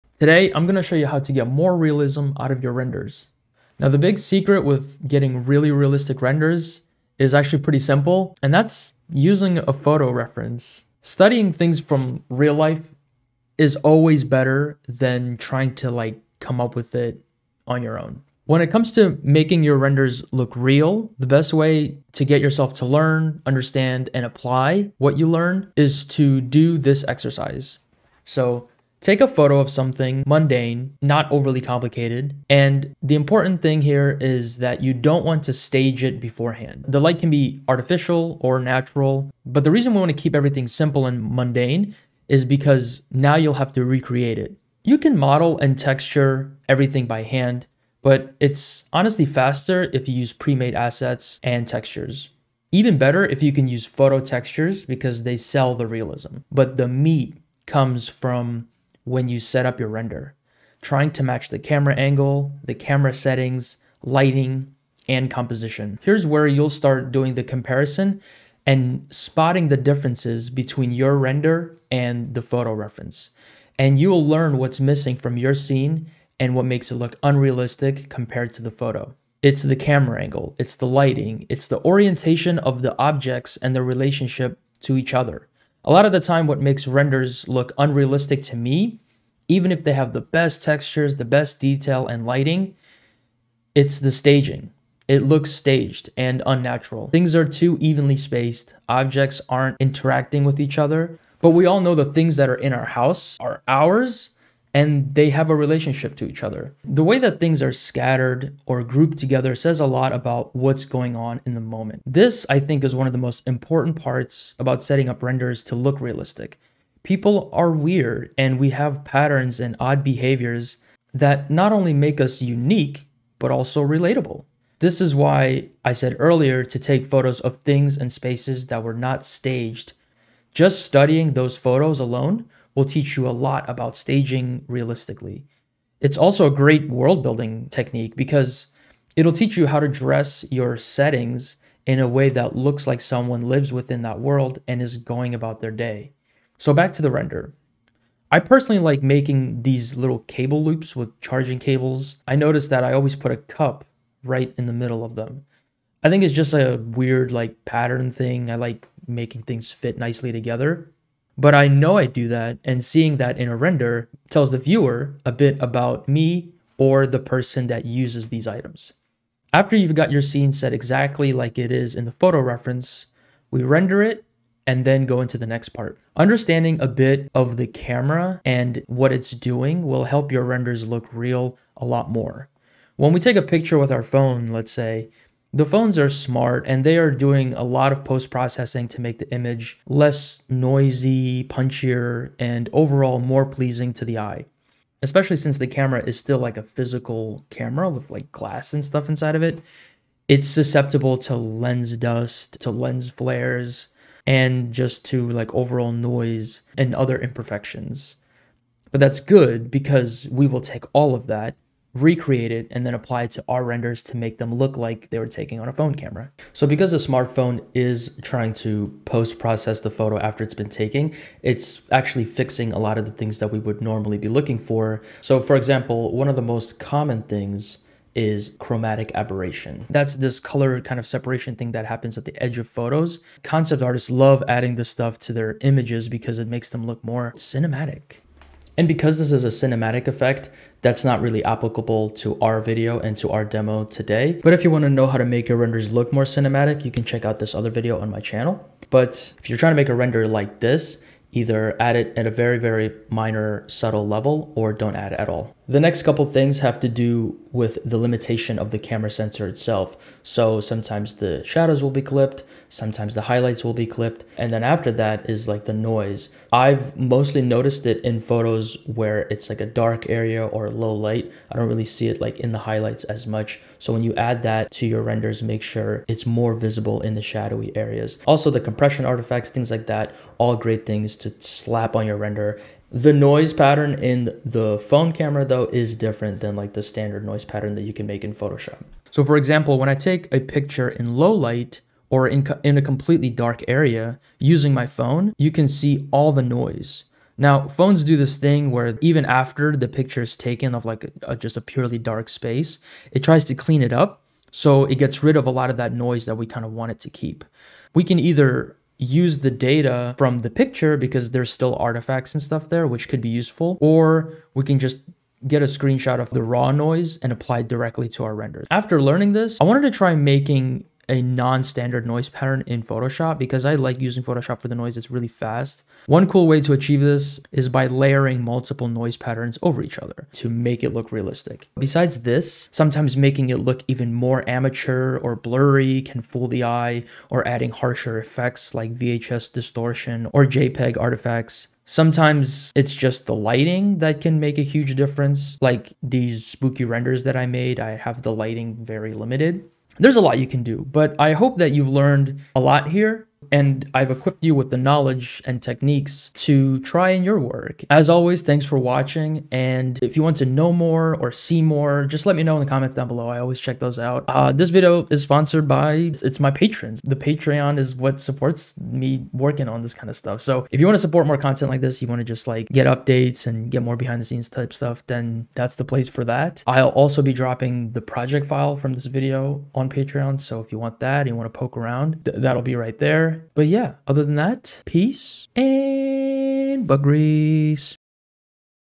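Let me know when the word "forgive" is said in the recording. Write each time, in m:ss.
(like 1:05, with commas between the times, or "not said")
not said.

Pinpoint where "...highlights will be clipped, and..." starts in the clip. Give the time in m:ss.
4:23.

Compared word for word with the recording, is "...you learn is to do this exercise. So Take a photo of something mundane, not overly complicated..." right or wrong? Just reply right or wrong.
right.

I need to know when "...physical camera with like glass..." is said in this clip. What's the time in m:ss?
3:16.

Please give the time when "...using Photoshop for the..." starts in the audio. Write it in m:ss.
5:23.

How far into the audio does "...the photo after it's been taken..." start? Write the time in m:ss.
3:39.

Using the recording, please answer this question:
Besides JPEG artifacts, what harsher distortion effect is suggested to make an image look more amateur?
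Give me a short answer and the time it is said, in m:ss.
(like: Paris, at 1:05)
VHS distortion, at 5:38.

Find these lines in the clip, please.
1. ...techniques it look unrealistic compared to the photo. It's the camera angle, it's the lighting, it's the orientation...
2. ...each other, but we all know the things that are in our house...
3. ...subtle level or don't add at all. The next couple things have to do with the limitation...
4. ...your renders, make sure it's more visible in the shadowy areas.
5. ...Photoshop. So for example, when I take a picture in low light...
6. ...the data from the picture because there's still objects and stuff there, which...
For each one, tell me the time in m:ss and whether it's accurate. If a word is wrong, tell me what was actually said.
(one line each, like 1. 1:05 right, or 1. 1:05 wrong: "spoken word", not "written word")
1. 1:16 wrong: "makes", not "techniques"
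2. 1:40 right
3. 4:13 right
4. 4:34 right
5. 4:48 right
6. 5:09 wrong: "artifacts", not "objects".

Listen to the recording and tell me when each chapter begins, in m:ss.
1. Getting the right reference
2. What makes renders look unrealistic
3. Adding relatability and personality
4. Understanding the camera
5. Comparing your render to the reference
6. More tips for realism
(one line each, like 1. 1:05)
1. 0:28
2. 1:26
3. 2:27
4. 2:56
5. 1:01
6. 5:31.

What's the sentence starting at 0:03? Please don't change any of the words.
Now, the big secret with getting really realistic renders is actually pretty simple, and that's using a photo reference.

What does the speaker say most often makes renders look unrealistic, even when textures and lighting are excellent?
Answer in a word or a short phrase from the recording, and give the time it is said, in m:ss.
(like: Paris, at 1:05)
the staging, at 1:33.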